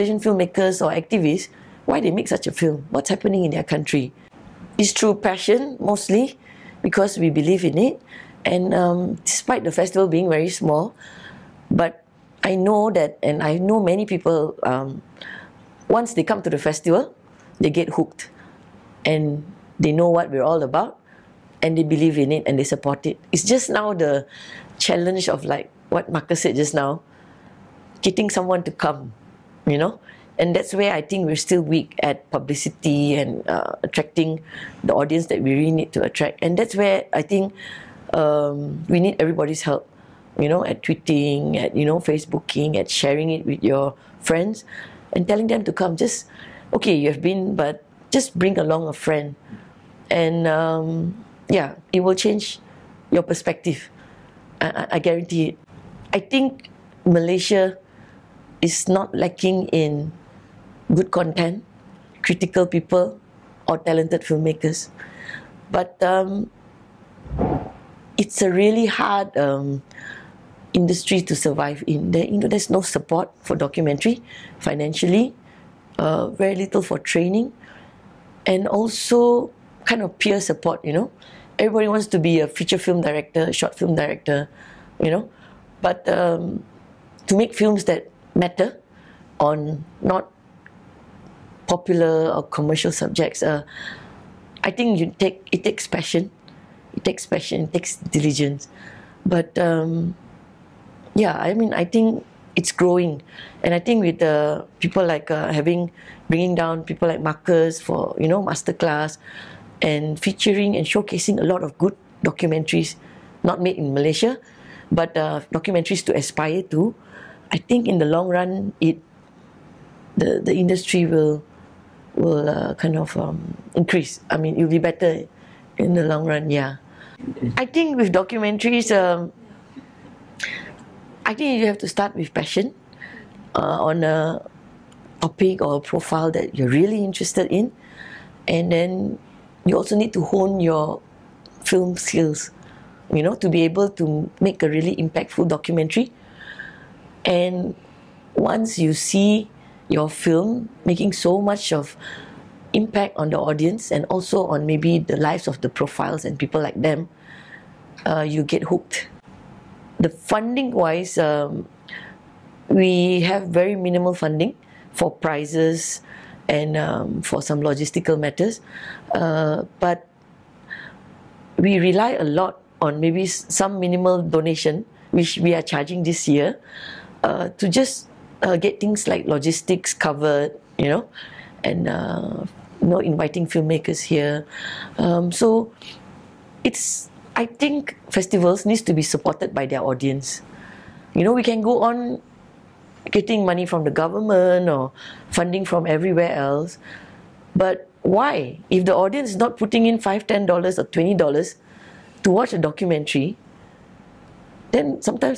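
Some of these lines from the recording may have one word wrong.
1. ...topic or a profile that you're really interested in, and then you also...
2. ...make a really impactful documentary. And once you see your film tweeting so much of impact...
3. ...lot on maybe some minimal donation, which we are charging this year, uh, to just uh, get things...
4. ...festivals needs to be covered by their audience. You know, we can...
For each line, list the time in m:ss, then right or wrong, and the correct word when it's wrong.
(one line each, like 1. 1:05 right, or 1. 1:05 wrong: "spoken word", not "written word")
1. 2:15 right
2. 2:24 wrong: "making", not "tweeting"
3. 2:52 right
4. 3:08 wrong: "supported", not "covered".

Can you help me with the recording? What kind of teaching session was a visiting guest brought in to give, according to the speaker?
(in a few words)
masterclass.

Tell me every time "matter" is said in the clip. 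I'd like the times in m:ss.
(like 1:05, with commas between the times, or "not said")
1:28, 2:48.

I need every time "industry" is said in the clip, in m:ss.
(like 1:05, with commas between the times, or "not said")
1:10, 2:00.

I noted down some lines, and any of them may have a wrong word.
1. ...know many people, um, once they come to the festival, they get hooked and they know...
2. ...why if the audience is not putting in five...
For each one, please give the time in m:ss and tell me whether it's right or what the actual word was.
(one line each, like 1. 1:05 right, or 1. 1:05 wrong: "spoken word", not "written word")
1. 0:13 right
2. 3:18 right.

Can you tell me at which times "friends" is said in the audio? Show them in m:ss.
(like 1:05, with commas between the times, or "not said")
0:44, 0:48.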